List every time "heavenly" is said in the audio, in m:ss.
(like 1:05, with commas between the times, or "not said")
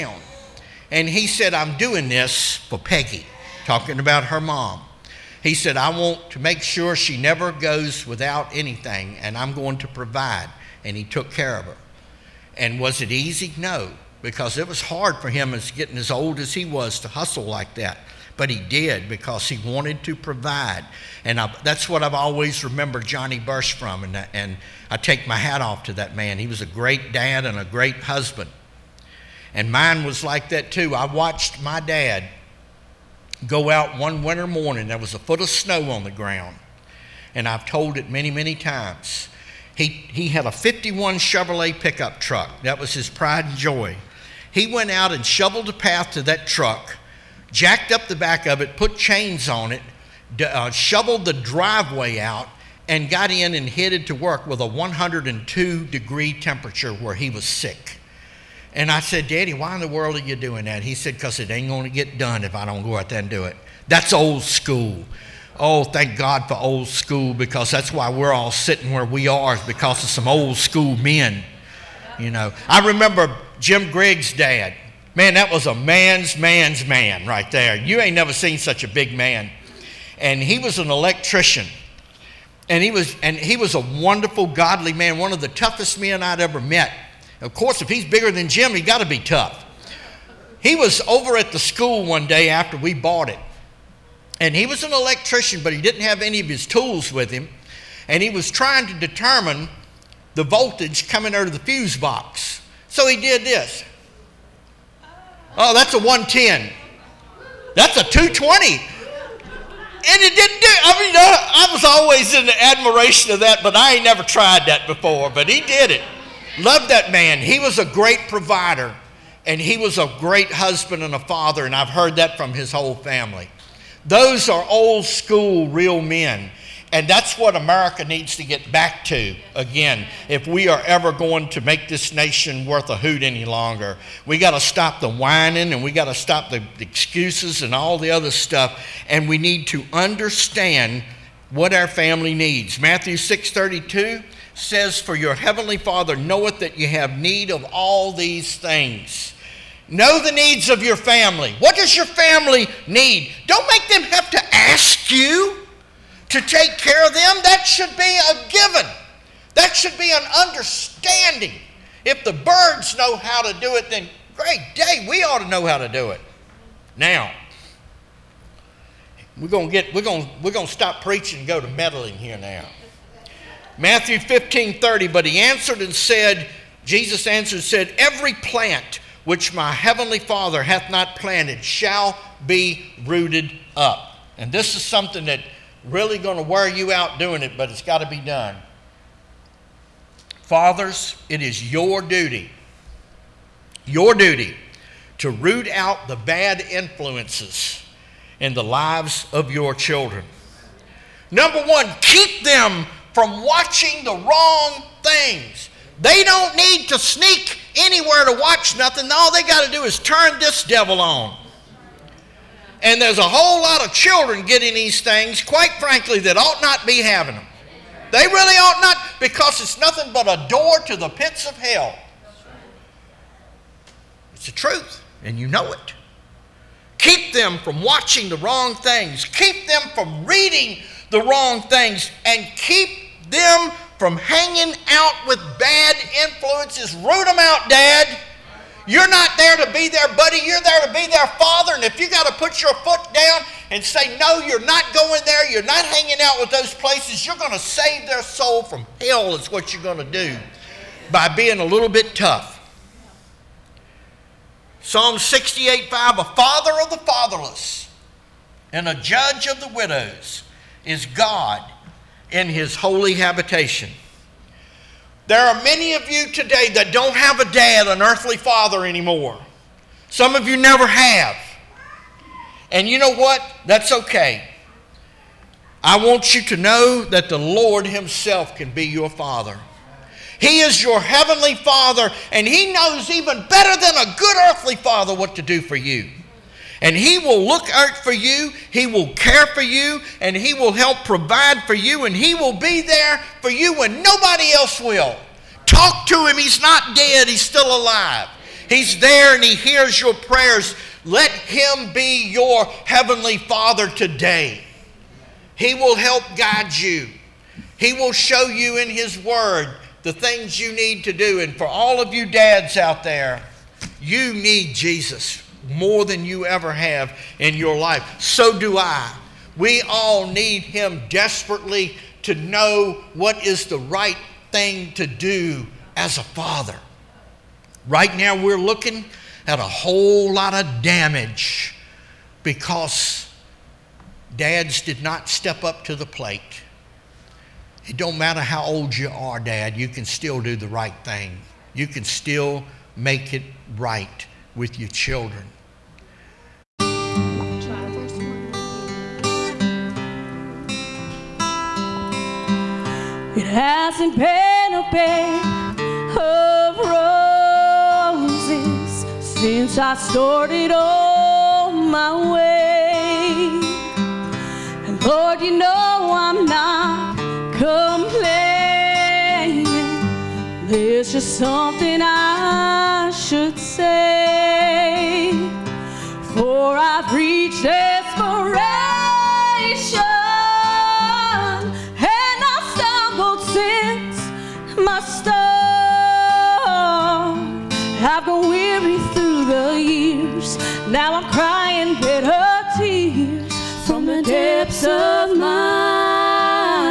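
2:25, 2:59, 4:40, 5:02.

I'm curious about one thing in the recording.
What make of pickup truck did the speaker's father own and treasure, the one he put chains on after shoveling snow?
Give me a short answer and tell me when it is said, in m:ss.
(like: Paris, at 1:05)
Chevrolet, at 0:41.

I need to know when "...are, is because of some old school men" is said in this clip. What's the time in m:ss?
1:09.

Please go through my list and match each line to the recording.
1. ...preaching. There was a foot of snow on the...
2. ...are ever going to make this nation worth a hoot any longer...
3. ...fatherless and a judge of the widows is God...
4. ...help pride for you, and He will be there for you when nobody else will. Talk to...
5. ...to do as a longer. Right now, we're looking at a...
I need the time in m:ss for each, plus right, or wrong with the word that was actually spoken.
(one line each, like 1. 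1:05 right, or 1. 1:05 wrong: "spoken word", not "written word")
1. 0:34 wrong: "morning", not "preaching"
2. 2:10 right
3. 4:16 right
4. 4:50 wrong: "provide", not "pride"
5. 5:24 wrong: "father", not "longer".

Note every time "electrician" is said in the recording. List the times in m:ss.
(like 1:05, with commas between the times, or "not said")
1:20, 1:34.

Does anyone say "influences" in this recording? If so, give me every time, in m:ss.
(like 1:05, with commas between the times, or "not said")
3:16, 3:56.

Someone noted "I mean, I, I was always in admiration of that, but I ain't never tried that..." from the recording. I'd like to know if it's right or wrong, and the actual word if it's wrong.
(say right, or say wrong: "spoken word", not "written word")
right.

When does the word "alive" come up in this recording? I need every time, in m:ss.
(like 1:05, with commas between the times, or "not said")
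4:57.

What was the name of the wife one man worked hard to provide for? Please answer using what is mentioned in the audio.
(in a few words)
Peggy.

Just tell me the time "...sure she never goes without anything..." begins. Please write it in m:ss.
0:06.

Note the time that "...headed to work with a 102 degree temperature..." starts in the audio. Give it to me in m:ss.
0:53.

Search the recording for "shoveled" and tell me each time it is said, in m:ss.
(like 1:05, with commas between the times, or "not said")
0:45, 0:50.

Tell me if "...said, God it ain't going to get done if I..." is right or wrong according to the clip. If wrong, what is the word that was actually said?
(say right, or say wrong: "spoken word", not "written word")
wrong: "Because", not "God".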